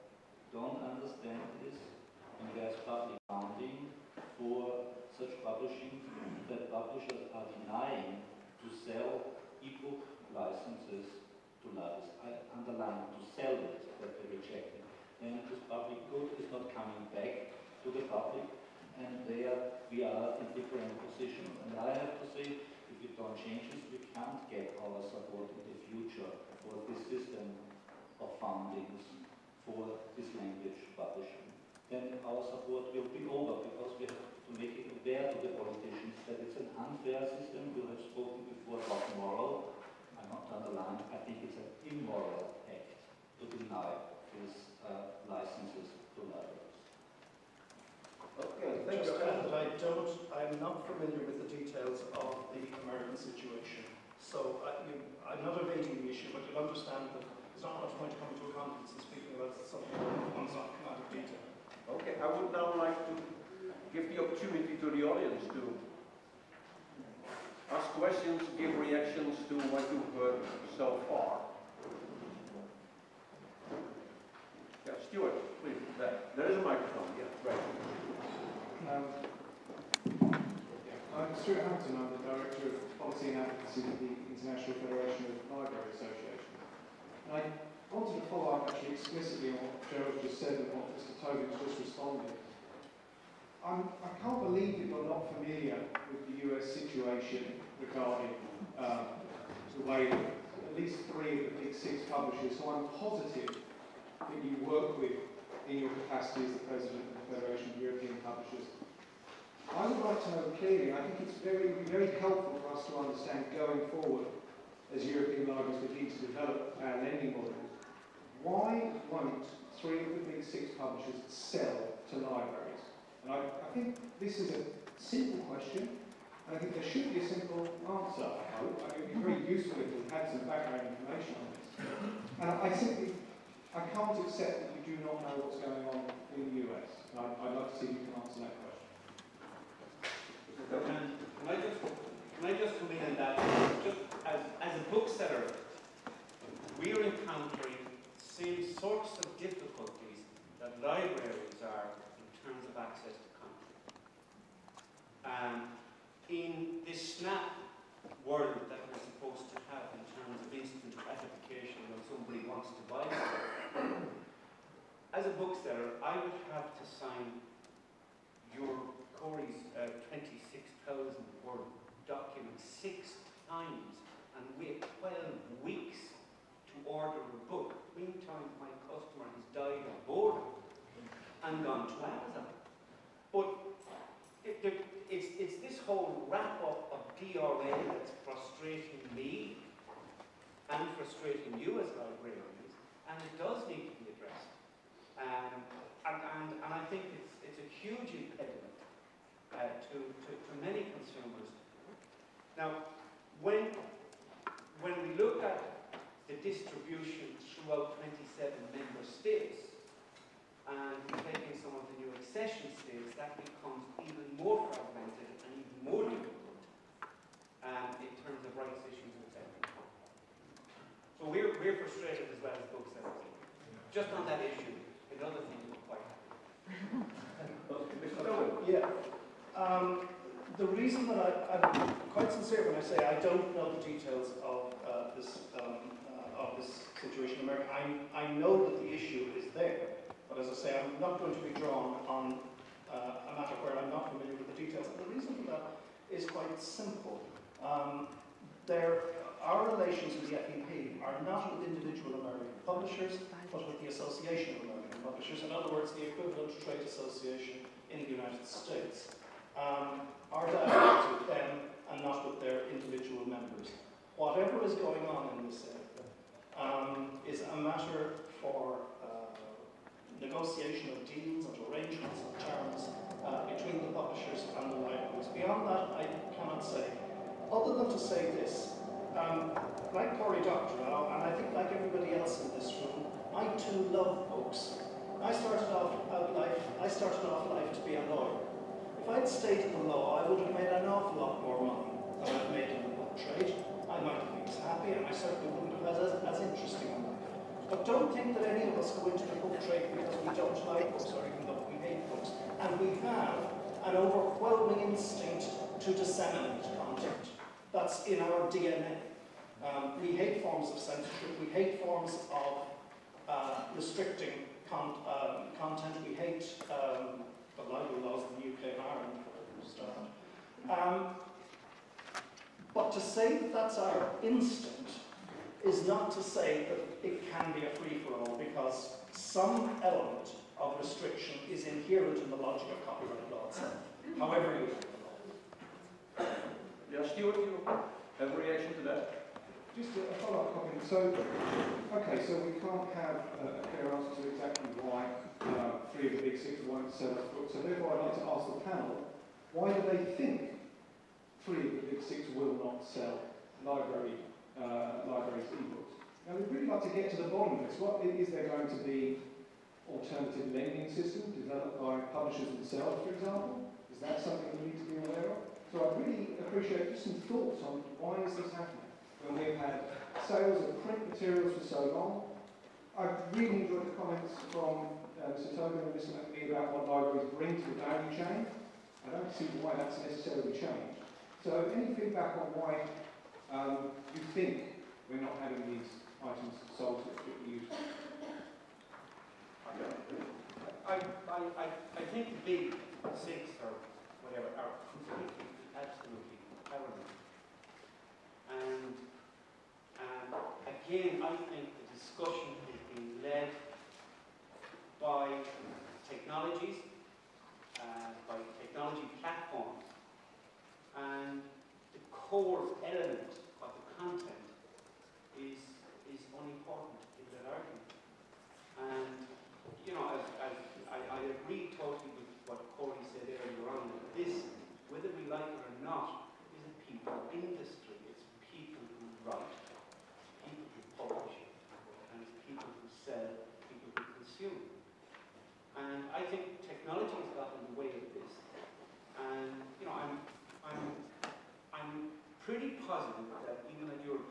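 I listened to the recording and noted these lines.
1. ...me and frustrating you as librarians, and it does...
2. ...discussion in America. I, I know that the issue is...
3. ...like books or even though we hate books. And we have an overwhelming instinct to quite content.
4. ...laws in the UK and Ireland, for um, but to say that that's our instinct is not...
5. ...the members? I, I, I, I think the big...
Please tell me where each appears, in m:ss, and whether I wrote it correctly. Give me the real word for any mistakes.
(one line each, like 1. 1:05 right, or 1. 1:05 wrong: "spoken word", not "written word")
1. 3:09 right
2. 3:56 wrong: "situation", not "discussion"
3. 5:00 wrong: "disseminate", not "quite"
4. 5:18 right
5. 6:27 wrong: "users", not "members".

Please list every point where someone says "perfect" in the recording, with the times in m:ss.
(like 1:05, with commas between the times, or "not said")
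not said.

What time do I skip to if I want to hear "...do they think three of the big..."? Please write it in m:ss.
5:49.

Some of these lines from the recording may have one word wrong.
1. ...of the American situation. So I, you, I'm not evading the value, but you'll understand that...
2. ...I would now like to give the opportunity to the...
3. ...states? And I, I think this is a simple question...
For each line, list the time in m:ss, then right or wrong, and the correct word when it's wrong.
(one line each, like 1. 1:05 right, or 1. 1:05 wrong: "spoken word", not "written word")
1. 0:52 wrong: "issue", not "value"
2. 1:02 right
3. 2:02 wrong: "libraries", not "states".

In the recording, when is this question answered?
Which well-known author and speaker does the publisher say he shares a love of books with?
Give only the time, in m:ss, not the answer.
4:40.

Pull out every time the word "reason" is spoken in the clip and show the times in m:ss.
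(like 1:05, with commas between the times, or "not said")
3:50, 4:05.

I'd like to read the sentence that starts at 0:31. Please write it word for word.
Then our support will be over because we have to make it aware to the politicians that it's an unfair system.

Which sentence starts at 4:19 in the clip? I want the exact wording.
Um, our dialogue with them and not with their individual members.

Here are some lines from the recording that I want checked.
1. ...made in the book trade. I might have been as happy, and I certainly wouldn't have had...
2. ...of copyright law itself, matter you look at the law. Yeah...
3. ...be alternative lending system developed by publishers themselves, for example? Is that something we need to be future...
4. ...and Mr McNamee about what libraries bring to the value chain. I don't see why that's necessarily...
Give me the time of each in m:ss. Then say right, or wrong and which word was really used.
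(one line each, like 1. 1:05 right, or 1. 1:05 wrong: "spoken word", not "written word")
1. 4:52 right
2. 5:32 wrong: "however", not "matter"
3. 5:58 wrong: "aware", not "future"
4. 6:15 right.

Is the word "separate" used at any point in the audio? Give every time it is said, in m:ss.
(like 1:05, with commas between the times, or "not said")
not said.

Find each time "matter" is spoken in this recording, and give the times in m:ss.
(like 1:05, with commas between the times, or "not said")
4:03, 4:27.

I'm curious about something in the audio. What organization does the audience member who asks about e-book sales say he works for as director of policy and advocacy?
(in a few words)
International Federation of Library Associations.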